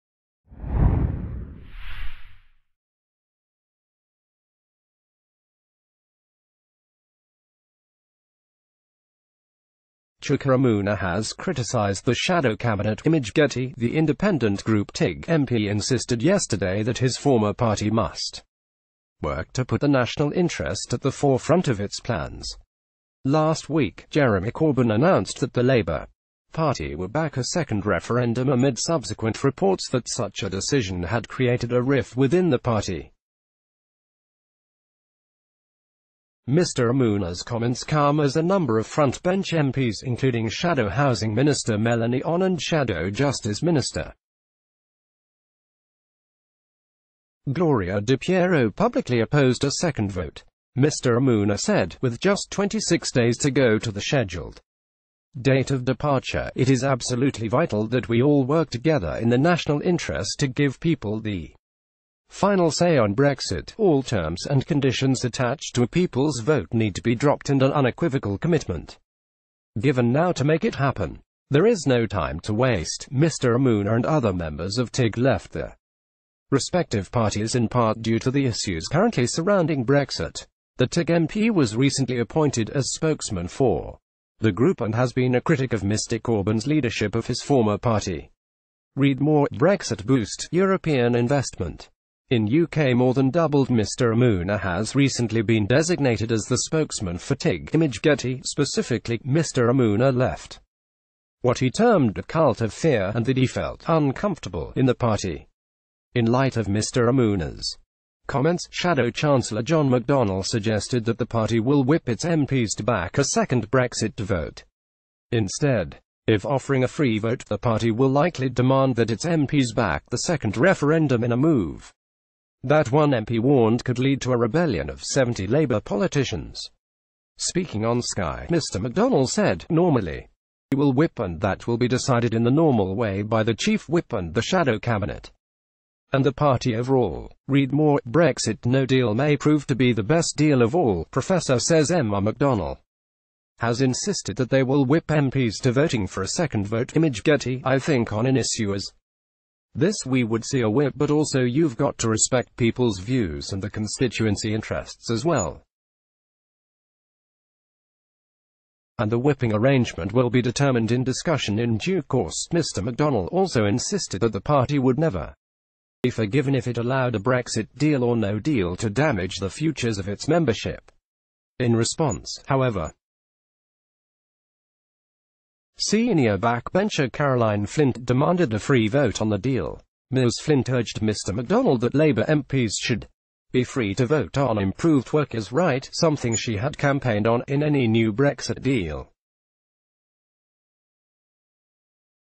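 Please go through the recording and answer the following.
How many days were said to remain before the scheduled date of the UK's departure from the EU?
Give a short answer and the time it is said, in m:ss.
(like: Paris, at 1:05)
26, at 0:52.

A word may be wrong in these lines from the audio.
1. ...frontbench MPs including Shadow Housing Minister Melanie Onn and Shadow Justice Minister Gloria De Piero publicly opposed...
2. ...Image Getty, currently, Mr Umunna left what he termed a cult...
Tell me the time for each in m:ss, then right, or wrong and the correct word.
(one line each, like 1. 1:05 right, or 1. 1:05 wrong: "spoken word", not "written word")
1. 0:38 right
2. 1:37 wrong: "specifically", not "currently".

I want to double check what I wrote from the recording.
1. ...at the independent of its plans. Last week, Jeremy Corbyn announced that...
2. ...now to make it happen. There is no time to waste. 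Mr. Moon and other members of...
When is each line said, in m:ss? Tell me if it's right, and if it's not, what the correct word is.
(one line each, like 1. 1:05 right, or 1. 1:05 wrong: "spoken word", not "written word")
1. 0:20 wrong: "forefront", not "independent"
2. 1:10 right.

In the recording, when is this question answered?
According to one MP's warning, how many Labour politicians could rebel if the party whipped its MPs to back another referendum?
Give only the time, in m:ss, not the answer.
2:05.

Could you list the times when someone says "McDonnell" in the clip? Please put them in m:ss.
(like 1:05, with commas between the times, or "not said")
1:49, 2:08, 2:22, 2:42, 3:01.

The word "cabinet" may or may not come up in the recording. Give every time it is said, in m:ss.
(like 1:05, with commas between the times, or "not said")
0:12, 2:14.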